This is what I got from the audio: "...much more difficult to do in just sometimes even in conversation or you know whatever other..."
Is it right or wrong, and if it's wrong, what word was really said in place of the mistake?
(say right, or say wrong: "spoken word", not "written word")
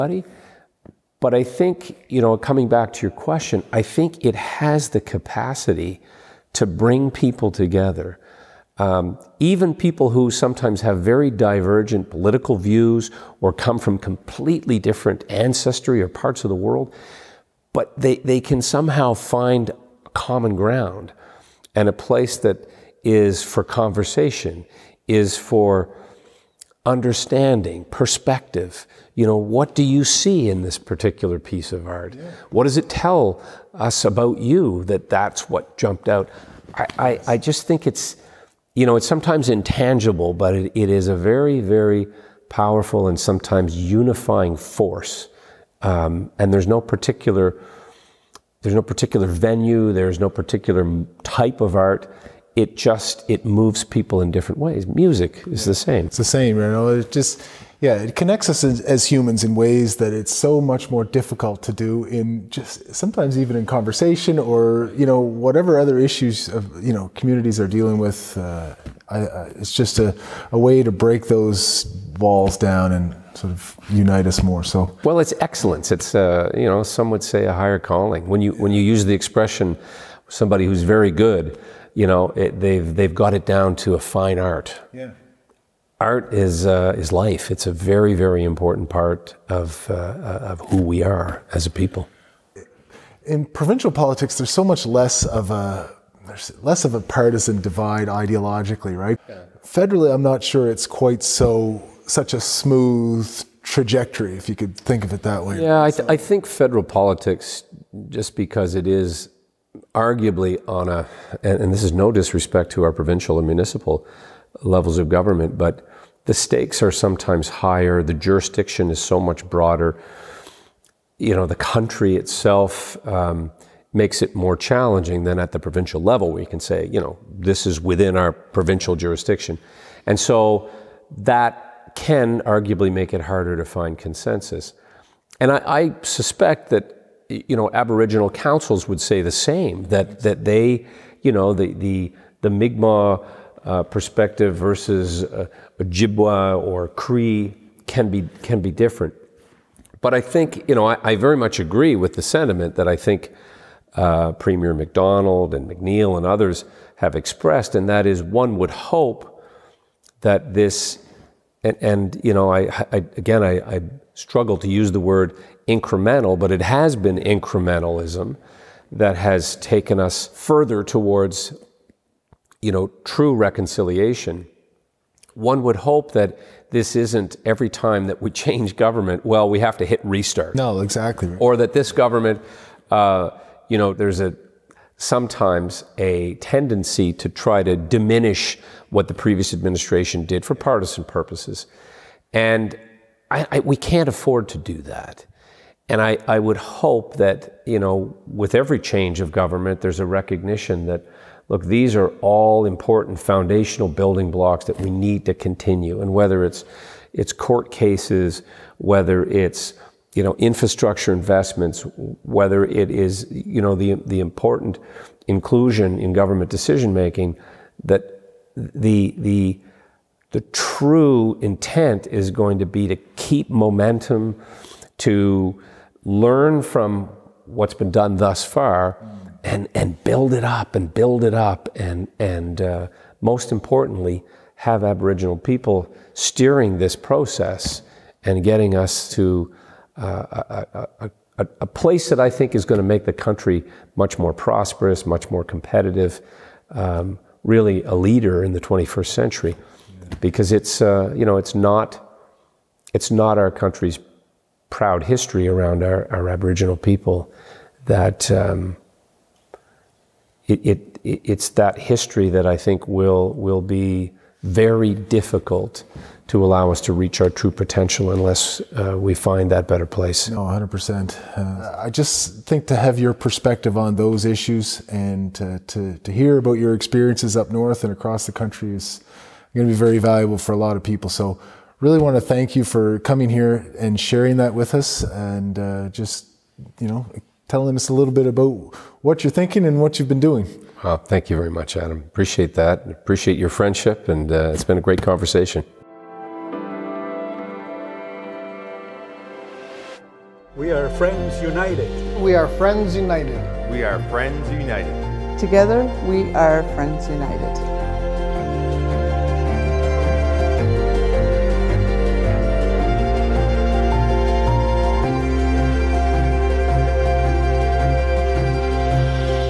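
right.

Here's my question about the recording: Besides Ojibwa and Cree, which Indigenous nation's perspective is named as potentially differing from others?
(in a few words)
Mi'kmaq.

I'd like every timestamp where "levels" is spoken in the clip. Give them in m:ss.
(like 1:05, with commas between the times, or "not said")
1:54, 2:06.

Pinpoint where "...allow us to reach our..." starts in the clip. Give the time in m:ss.
4:26.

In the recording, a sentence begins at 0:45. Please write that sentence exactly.
Um, and there's no particular there's no particular venue, there's no particular type of art.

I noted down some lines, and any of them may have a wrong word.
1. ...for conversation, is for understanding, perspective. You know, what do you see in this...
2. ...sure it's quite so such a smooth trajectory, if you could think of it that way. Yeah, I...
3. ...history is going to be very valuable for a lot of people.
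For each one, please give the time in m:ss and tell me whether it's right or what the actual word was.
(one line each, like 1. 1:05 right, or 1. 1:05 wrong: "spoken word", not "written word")
1. 0:23 right
2. 1:40 right
3. 4:38 wrong: "country", not "history".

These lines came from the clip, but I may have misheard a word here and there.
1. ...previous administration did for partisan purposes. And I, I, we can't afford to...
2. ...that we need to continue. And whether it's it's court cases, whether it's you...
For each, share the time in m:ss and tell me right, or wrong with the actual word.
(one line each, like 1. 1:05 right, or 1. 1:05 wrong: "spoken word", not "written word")
1. 3:09 right
2. 3:24 right.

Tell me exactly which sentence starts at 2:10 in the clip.
And so that can arguably make it harder to find consensus.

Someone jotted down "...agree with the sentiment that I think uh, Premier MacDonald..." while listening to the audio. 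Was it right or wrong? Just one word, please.
right.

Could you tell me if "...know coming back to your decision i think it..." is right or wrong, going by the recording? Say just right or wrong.
wrong.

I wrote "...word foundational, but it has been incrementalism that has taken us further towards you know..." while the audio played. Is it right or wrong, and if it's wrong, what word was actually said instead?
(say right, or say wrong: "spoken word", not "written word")
wrong: "incremental", not "foundational".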